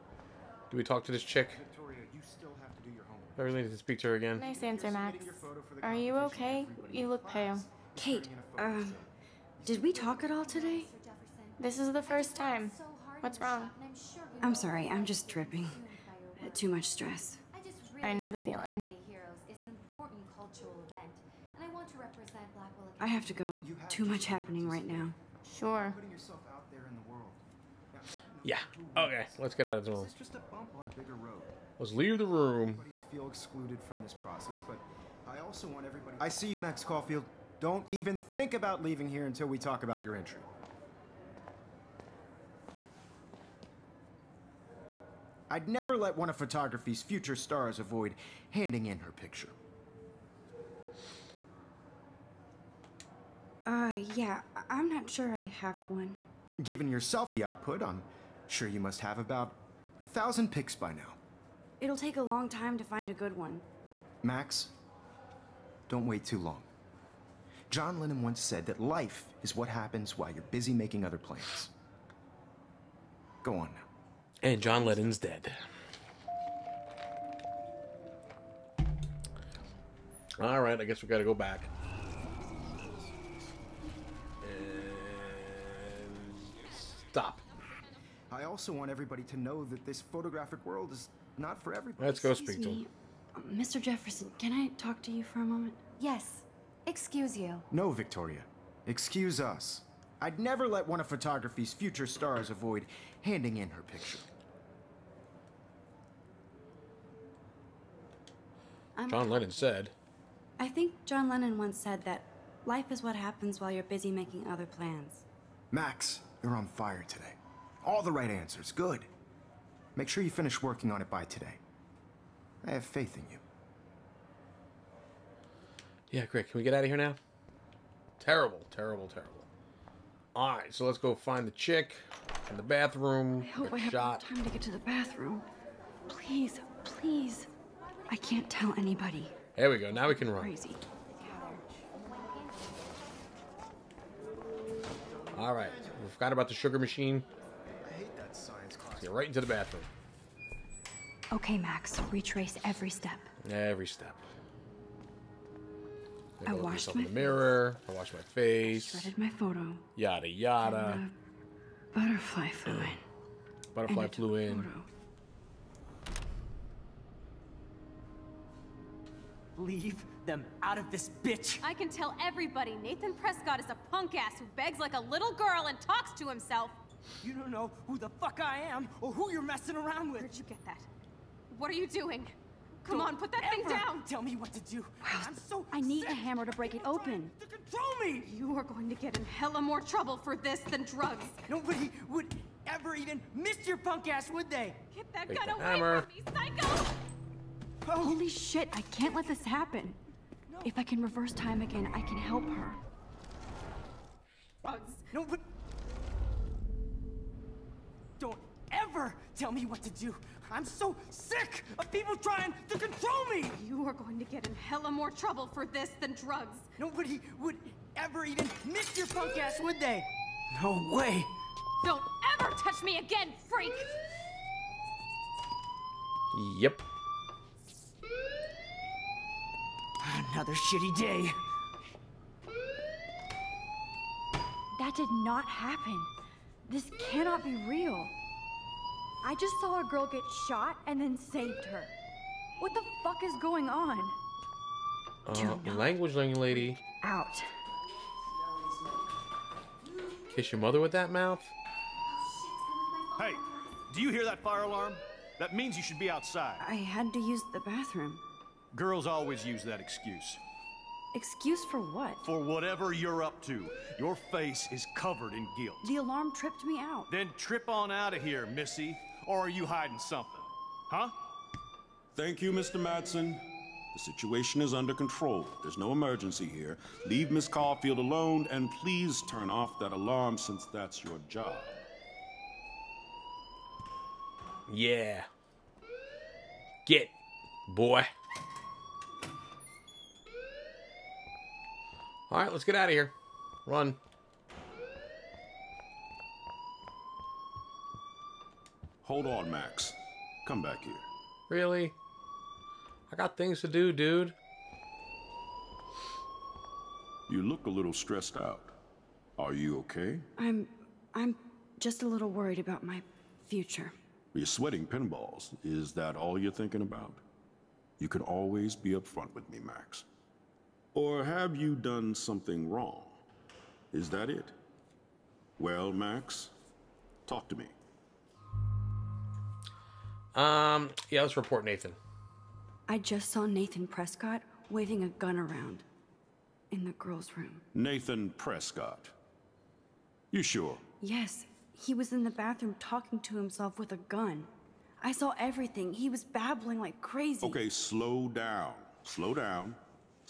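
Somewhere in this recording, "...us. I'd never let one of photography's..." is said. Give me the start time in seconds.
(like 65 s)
99 s.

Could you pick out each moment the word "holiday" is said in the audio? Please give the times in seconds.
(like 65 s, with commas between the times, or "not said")
not said.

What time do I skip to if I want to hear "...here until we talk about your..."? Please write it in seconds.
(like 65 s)
39 s.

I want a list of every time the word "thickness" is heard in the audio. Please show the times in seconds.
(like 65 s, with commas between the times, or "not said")
not said.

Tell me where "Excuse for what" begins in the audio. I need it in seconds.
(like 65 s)
261 s.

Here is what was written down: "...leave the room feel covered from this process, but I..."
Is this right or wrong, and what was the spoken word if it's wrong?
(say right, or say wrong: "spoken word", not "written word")
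wrong: "excluded", not "covered".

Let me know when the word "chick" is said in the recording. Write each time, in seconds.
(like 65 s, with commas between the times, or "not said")
1 s, 131 s.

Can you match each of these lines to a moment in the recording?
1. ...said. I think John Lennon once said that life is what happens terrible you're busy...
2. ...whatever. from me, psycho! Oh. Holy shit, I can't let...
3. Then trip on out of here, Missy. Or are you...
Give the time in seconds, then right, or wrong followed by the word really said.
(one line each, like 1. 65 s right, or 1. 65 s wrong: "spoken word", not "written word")
1. 109 s wrong: "while", not "terrible"
2. 195 s wrong: "hammer", not "whatever"
3. 267 s right.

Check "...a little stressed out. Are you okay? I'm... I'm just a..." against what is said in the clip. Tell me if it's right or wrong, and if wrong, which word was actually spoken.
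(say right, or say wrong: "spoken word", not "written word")
right.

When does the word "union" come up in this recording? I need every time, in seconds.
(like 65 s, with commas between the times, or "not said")
not said.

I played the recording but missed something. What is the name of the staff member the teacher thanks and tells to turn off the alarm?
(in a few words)
Mr. Madsen.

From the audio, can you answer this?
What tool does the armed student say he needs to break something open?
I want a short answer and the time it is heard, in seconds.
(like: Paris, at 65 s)
a hammer, at 186 s.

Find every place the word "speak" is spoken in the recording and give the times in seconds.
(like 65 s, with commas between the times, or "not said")
3 s, 92 s.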